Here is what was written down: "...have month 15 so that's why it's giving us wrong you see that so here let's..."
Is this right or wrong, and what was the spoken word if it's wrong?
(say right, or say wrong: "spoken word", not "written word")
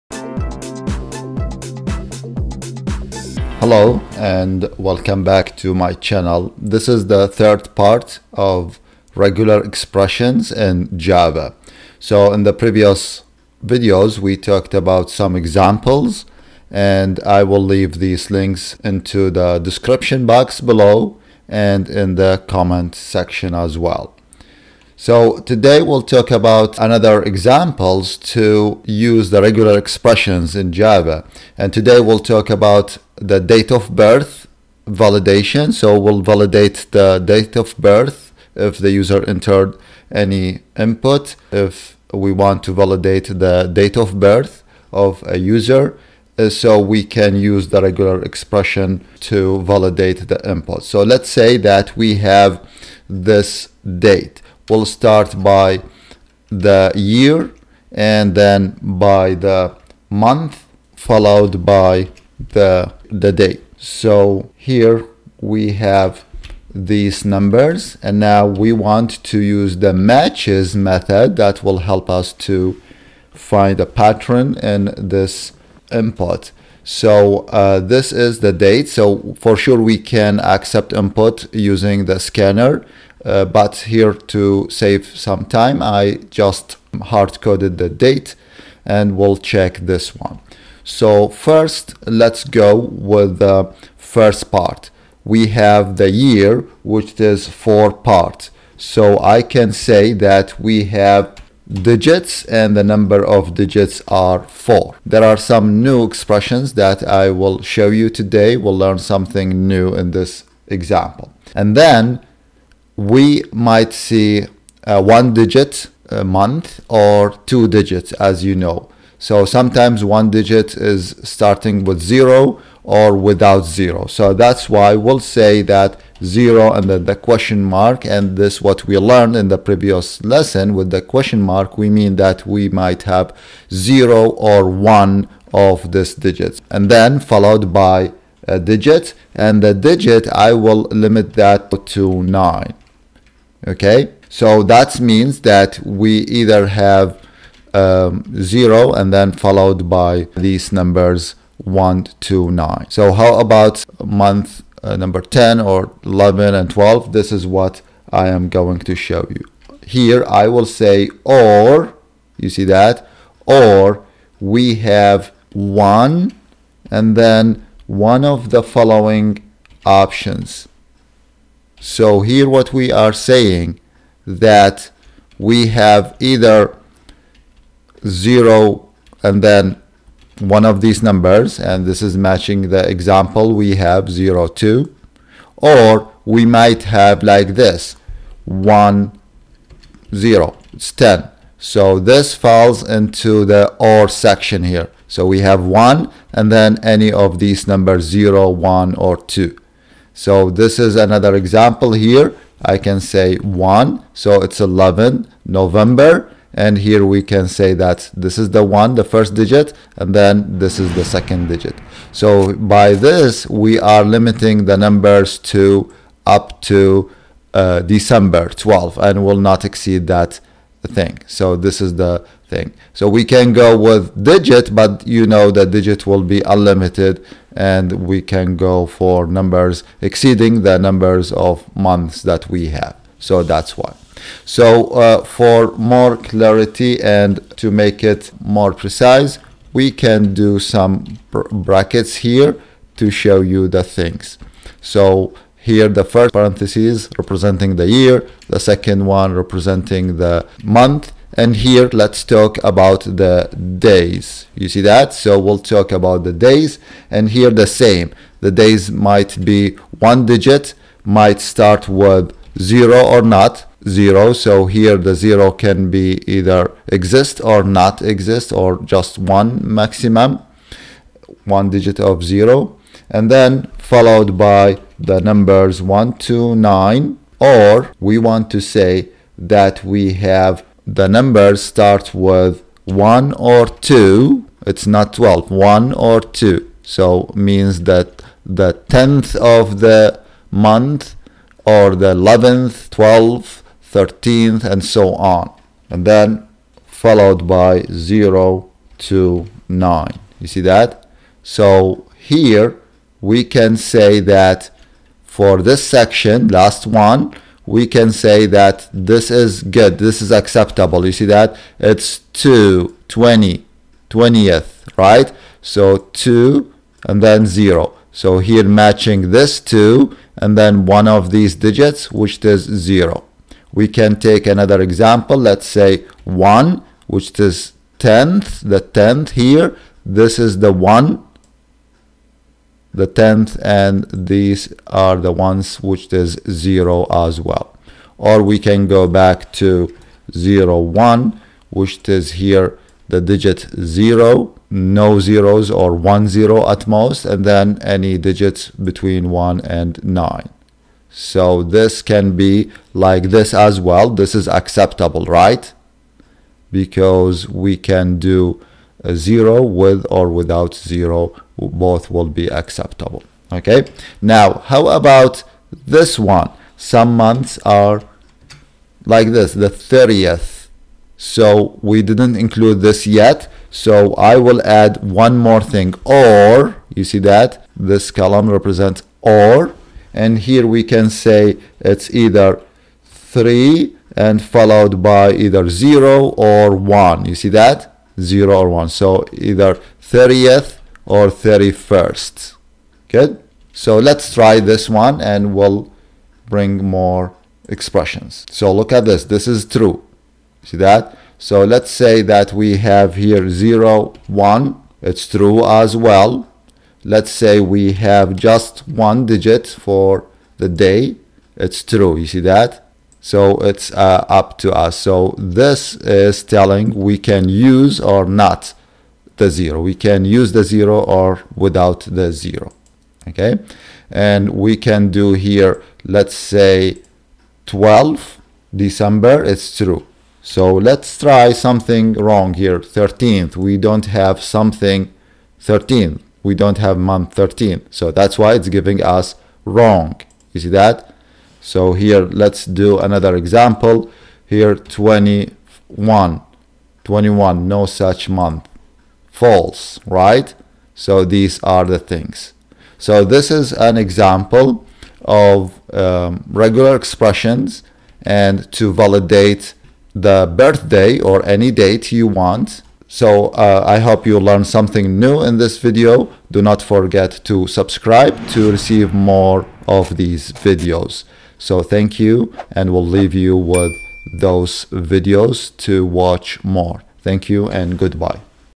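wrong: "13", not "15".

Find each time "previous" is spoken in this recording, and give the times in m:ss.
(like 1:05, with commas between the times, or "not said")
0:12, 2:09.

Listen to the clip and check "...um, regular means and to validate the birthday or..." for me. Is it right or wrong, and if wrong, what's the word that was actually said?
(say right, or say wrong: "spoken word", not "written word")
wrong: "expressions", not "means".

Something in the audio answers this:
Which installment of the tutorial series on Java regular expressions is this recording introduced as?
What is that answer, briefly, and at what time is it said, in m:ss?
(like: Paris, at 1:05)
third part, at 0:07.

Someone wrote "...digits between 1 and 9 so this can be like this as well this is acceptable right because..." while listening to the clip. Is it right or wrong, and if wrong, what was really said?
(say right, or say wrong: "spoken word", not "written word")
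right.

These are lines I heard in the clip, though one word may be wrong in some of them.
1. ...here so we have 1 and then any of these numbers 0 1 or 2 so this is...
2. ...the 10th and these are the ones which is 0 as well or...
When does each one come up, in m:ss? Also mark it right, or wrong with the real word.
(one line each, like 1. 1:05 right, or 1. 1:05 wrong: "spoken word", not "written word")
1. 3:14 right
2. 5:32 right.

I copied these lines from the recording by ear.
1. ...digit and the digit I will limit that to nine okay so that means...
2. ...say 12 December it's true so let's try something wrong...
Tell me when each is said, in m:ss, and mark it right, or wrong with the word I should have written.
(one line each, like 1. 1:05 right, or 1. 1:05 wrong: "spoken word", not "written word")
1. 2:18 right
2. 7:06 right.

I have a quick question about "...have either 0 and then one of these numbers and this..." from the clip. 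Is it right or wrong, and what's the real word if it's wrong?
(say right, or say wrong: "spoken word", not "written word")
right.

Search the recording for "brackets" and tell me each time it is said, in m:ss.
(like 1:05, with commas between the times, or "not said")
4:01.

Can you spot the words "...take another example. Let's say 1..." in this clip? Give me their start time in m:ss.
5:24.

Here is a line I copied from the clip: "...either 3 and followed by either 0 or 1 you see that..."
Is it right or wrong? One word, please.
right.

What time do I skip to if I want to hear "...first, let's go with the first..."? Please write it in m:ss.
1:31.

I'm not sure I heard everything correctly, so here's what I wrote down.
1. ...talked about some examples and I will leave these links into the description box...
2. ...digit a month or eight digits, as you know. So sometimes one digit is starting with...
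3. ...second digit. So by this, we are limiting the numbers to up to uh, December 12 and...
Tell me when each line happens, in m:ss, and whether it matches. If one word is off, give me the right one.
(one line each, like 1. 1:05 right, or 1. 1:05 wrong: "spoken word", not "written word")
1. 0:14 right
2. 1:55 wrong: "two", not "eight"
3. 3:31 right.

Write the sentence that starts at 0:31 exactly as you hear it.
And today we'll talk about the date of birth validation.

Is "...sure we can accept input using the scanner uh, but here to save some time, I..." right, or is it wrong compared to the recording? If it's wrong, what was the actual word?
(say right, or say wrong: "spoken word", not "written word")
right.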